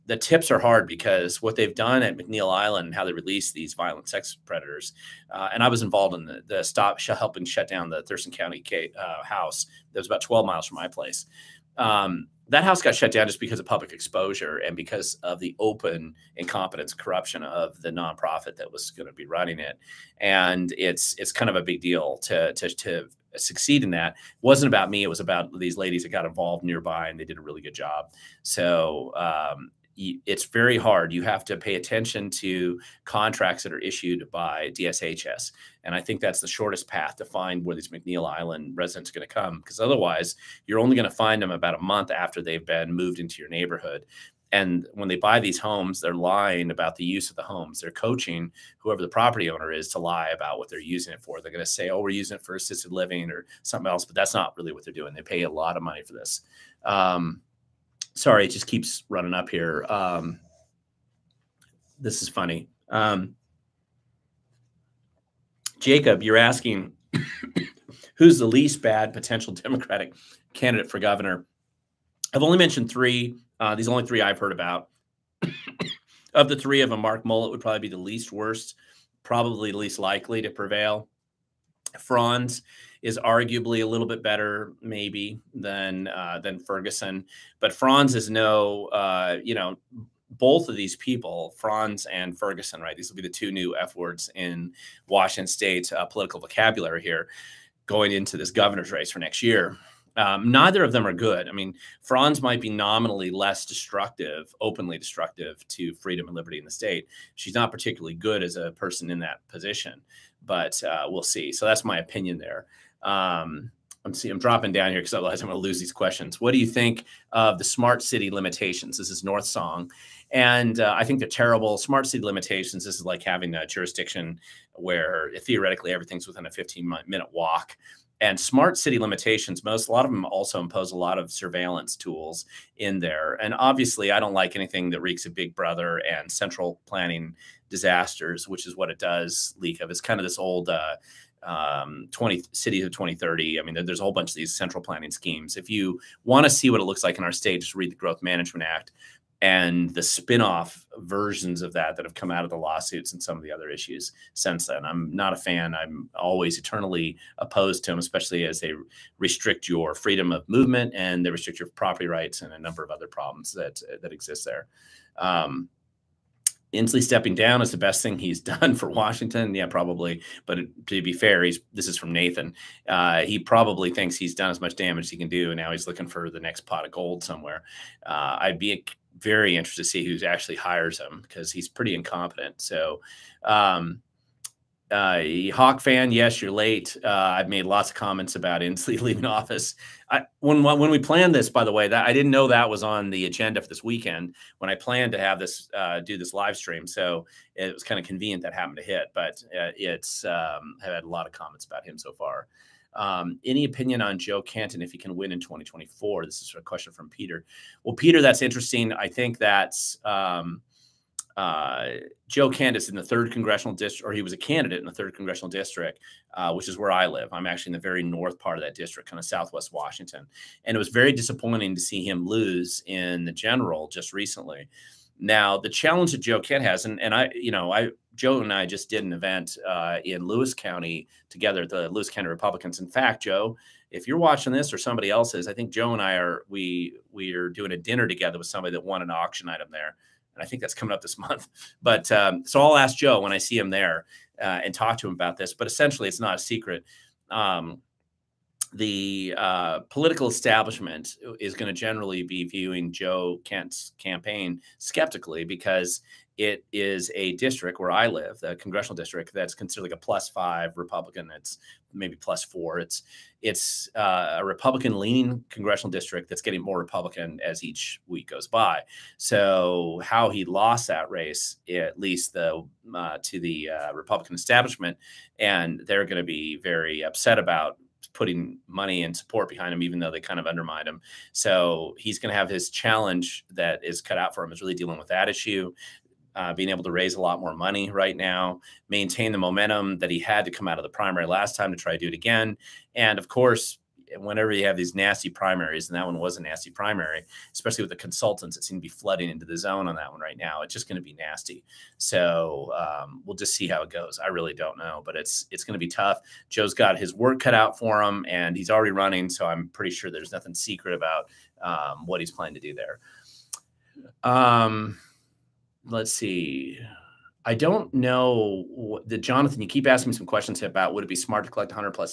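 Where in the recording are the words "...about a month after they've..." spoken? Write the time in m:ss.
0:41.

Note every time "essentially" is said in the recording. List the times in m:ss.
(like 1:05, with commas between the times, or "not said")
4:05.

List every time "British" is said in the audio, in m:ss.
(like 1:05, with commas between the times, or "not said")
not said.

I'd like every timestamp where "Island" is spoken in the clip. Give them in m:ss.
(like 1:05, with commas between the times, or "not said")
0:02, 0:38.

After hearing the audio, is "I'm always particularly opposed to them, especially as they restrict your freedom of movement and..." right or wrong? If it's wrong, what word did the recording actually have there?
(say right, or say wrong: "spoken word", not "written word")
wrong: "eternally", not "particularly".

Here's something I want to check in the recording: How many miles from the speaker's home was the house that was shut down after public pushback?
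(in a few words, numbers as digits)
12.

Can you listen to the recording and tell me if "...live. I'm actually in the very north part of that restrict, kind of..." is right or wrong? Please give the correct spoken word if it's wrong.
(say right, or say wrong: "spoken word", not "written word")
wrong: "district", not "restrict".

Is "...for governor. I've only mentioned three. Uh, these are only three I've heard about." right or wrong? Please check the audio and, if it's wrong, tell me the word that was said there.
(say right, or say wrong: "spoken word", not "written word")
right.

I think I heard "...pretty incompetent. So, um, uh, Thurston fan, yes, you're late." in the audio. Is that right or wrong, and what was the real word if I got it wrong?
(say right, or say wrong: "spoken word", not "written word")
wrong: "Hawk", not "Thurston".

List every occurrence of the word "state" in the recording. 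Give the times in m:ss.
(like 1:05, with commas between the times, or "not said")
1:35, 1:46, 2:27.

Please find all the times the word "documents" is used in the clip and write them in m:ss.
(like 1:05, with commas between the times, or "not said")
not said.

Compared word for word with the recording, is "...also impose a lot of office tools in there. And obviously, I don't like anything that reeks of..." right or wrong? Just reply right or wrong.
wrong.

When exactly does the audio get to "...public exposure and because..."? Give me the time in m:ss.
0:13.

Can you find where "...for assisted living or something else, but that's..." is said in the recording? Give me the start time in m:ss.
0:52.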